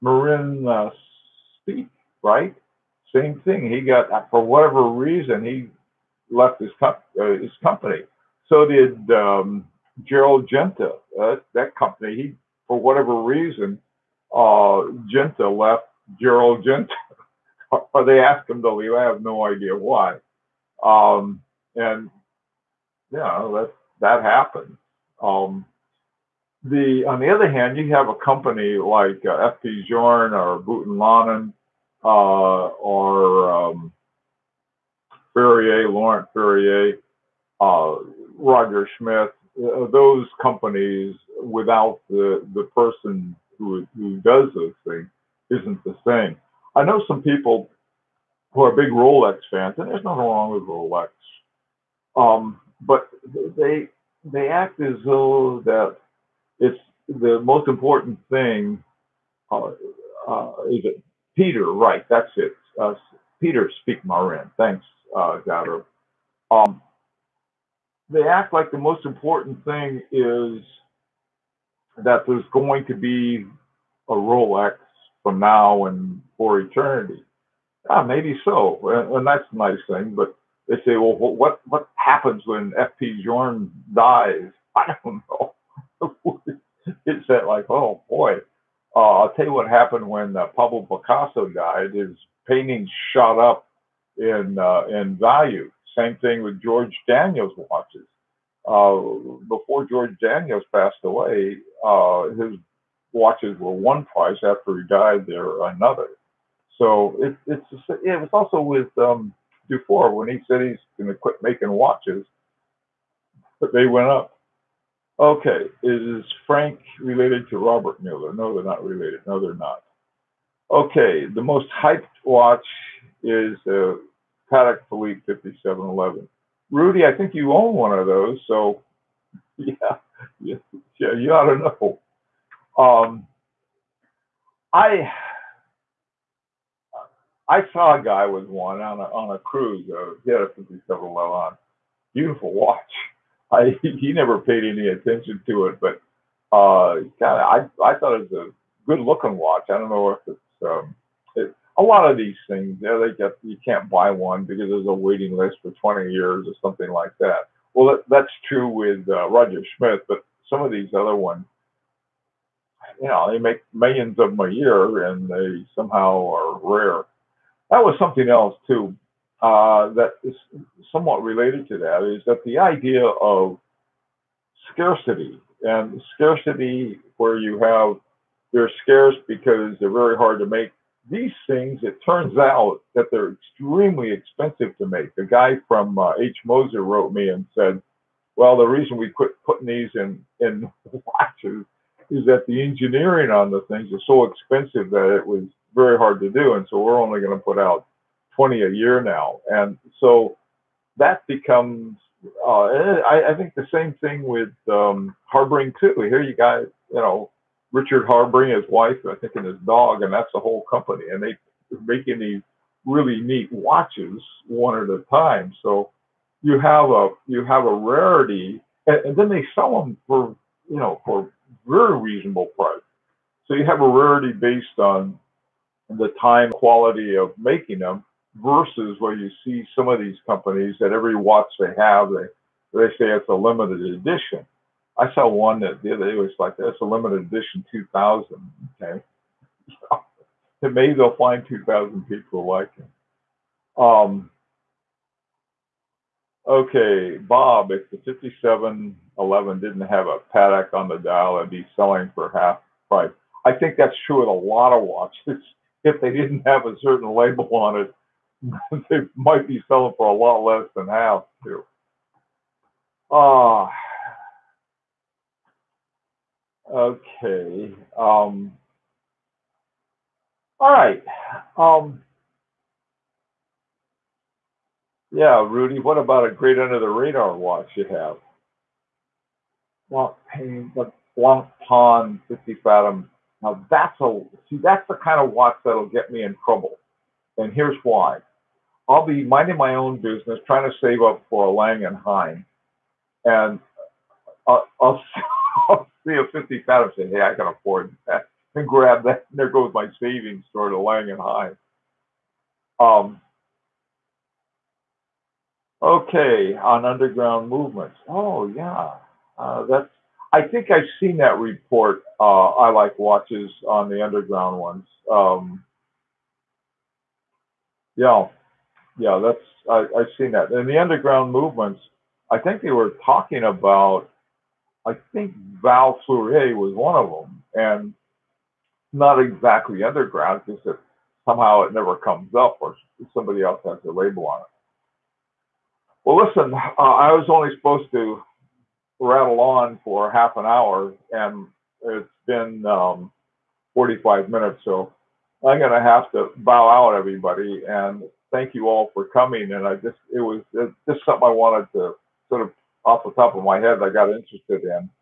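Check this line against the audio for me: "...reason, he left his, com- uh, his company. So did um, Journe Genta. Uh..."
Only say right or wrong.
wrong.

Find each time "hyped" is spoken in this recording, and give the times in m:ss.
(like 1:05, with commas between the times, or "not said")
2:01.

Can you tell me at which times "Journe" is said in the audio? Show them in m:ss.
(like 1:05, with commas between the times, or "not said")
0:29, 1:23.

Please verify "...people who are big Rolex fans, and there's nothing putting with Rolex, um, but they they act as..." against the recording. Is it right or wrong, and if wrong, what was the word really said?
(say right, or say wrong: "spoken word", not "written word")
wrong: "wrong", not "putting".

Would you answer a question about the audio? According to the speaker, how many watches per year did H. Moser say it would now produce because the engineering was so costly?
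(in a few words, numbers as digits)
20.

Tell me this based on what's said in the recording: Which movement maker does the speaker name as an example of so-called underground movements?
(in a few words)
Val Fleurier.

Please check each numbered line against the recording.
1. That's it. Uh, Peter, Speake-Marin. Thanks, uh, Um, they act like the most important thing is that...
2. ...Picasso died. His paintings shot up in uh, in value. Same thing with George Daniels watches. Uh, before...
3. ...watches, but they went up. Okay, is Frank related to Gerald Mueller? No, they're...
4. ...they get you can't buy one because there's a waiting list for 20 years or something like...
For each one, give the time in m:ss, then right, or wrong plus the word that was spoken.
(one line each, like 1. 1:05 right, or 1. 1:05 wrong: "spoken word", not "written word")
1. 1:02 right
2. 1:30 right
3. 1:51 wrong: "Robert", not "Gerald"
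4. 2:32 right.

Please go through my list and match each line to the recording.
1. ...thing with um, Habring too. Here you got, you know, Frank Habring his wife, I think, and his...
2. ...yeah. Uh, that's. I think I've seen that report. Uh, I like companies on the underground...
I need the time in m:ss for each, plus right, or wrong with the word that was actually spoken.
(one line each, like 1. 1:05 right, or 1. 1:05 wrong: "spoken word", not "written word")
1. 3:24 wrong: "Richard", not "Frank"
2. 5:08 wrong: "watches", not "companies".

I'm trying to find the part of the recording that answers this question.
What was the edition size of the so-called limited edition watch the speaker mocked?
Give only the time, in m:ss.
3:56.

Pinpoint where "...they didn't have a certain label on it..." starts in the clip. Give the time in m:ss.
4:15.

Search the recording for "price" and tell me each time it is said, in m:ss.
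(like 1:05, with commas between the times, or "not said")
1:44, 3:42, 4:12.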